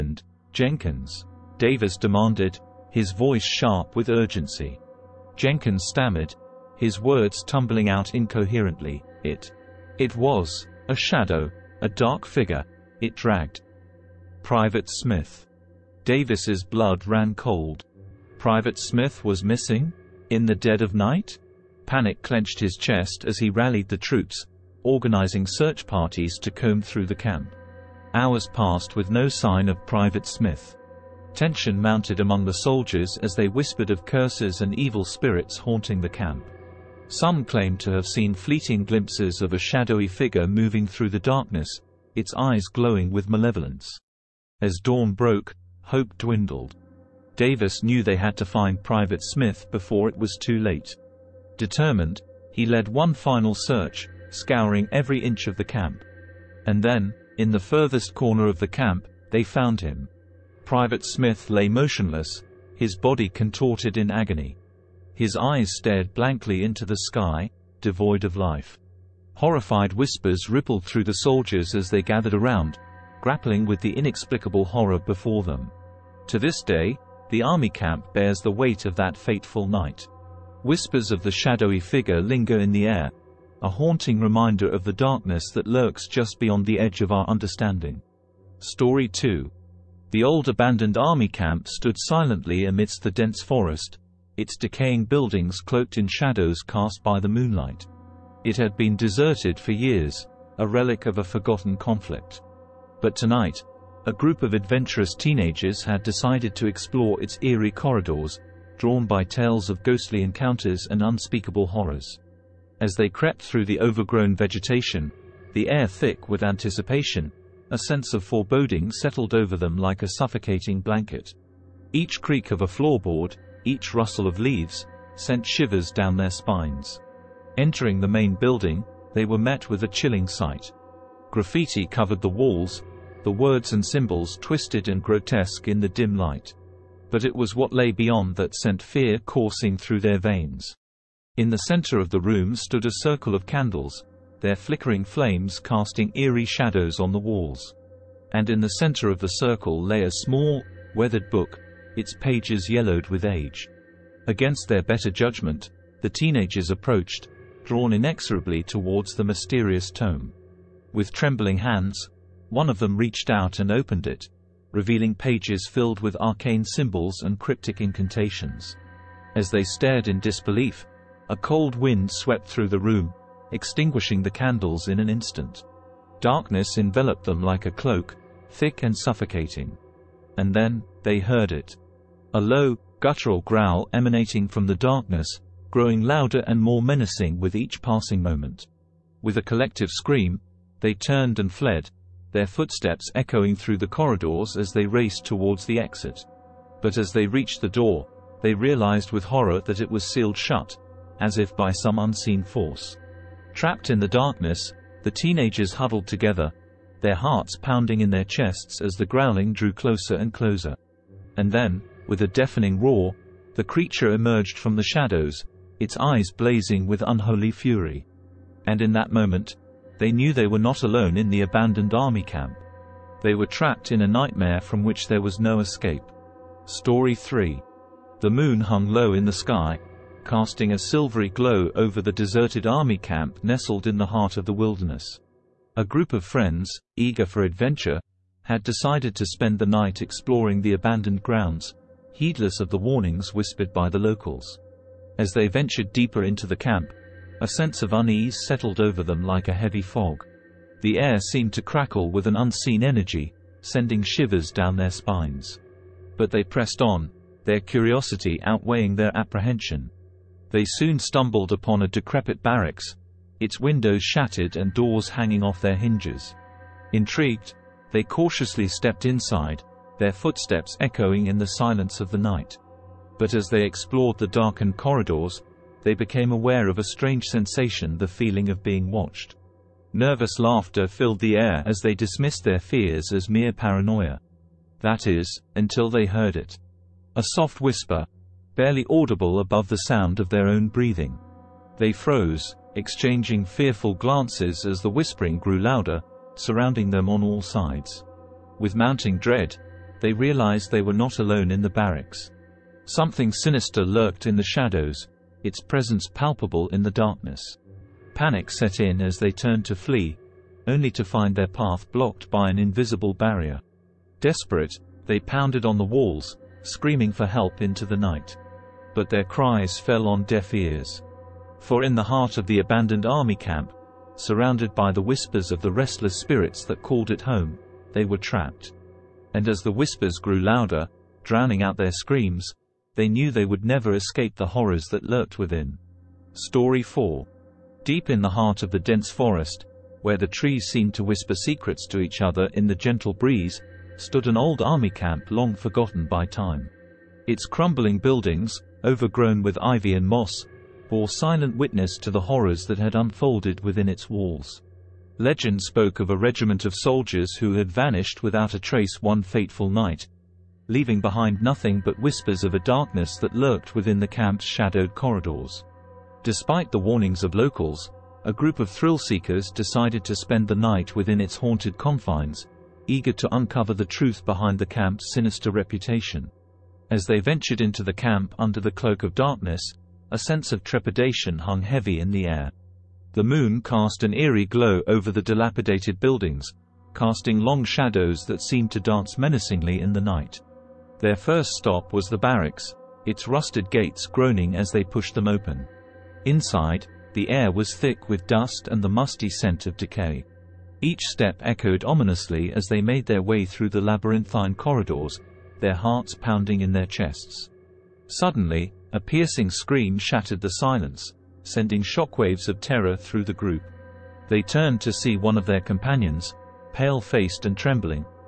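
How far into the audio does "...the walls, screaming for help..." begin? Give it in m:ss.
5:15.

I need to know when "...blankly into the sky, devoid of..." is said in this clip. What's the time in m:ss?
1:06.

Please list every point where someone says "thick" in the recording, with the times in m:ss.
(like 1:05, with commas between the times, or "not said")
1:55, 2:58, 6:37.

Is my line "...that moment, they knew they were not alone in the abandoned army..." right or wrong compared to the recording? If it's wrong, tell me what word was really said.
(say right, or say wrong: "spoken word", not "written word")
right.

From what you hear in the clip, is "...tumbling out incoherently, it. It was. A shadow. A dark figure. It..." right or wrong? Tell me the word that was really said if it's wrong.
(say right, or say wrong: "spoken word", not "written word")
right.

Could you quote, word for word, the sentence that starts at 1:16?
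To this day, the army camp bears the weight of that fateful night.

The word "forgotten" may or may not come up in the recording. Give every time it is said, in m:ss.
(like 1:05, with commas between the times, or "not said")
1:41, 5:45.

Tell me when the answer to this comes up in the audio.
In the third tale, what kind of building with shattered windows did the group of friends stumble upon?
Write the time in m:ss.
4:21.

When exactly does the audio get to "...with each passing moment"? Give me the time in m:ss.
3:07.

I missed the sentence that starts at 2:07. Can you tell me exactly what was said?
Entering the main building, they were met with a chilling sight.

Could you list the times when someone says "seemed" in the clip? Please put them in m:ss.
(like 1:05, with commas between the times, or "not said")
4:11, 5:40, 6:28.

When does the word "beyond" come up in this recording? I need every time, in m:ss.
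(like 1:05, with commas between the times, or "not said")
1:26, 2:17.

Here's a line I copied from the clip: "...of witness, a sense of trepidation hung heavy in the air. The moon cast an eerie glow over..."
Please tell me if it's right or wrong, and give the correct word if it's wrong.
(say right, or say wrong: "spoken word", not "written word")
wrong: "darkness", not "witness".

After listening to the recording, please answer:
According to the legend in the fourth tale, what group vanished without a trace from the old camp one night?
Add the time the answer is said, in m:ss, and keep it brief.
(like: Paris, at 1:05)
A regiment of soldiers, at 5:56.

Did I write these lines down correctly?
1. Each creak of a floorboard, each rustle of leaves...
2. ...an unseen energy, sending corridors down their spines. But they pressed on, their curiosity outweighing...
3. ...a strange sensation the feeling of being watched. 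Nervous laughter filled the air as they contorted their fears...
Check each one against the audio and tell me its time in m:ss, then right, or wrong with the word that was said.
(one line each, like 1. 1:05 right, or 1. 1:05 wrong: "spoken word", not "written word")
1. 2:01 right
2. 4:12 wrong: "shivers", not "corridors"
3. 4:36 wrong: "dismissed", not "contorted".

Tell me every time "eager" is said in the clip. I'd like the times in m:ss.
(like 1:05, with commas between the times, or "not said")
3:56, 6:12.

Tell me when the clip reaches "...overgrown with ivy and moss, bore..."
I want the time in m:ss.
5:48.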